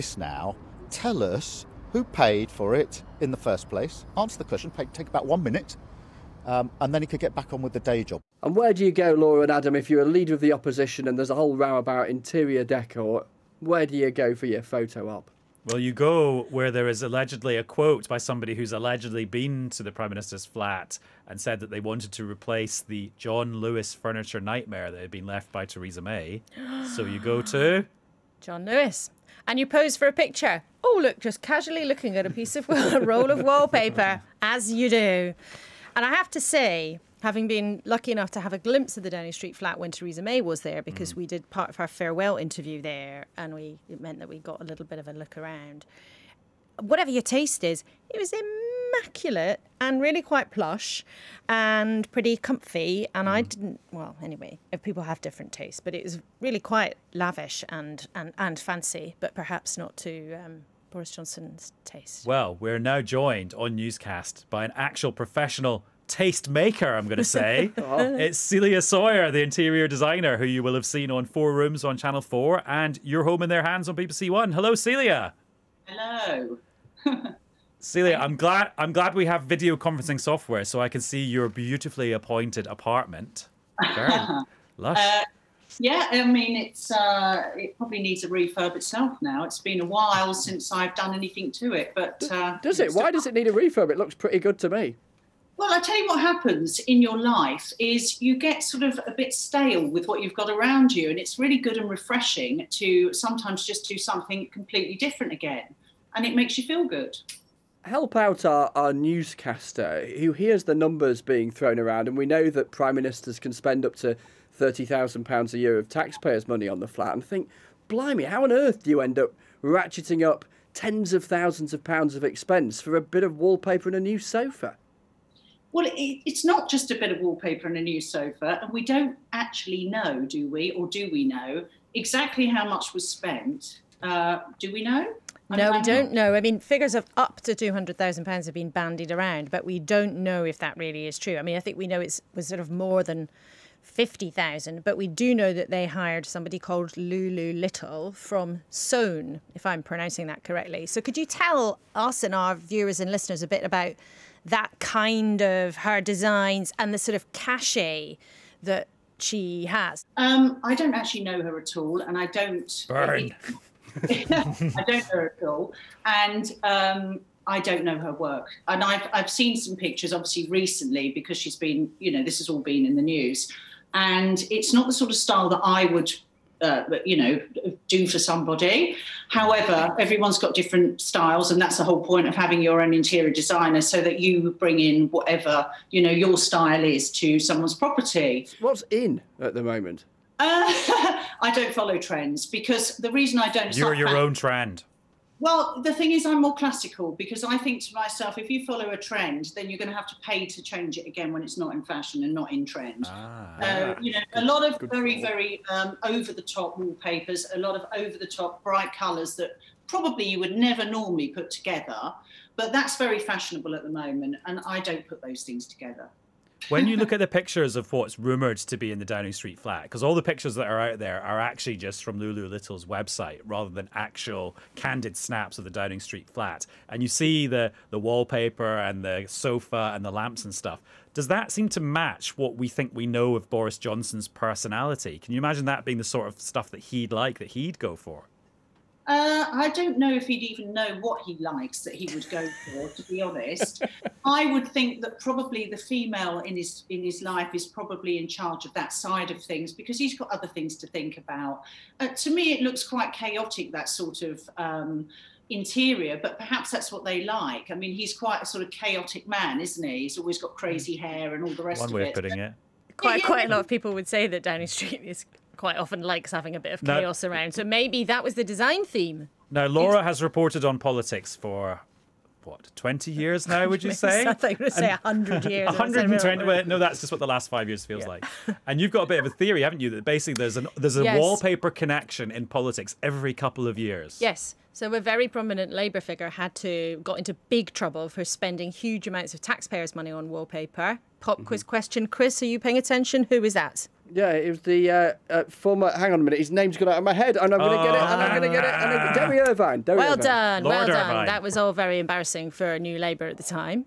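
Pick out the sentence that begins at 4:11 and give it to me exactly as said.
Uh, to me, it looks quite chaotic that sort of um, interior, but perhaps that's what they like.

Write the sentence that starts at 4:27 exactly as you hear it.
So maybe that was the design theme.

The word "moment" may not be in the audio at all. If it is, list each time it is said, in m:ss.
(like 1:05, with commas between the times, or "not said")
3:09, 3:33.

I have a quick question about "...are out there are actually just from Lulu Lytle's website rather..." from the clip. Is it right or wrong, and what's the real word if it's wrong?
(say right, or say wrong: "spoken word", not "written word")
right.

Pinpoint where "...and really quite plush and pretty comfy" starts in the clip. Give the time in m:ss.
0:49.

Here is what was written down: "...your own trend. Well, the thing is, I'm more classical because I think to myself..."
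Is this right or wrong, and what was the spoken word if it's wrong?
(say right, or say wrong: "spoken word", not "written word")
right.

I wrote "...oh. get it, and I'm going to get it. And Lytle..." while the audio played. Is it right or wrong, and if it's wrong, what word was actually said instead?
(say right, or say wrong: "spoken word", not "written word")
wrong: "Derry", not "Lytle".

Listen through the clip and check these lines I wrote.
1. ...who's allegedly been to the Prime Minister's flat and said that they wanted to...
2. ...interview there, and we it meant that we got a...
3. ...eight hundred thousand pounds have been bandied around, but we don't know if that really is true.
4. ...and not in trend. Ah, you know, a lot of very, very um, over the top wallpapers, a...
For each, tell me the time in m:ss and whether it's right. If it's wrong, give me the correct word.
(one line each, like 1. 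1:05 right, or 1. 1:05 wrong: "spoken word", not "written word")
1. 0:18 right
2. 0:42 right
3. 2:17 wrong: "two", not "eight"
4. 3:22 right.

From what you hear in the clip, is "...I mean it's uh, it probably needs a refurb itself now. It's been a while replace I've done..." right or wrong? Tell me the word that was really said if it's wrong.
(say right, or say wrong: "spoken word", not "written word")
wrong: "since", not "replace".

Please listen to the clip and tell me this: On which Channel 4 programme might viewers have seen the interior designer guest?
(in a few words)
Four Rooms.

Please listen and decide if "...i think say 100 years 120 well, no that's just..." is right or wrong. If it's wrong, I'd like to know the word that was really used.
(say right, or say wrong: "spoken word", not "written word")
right.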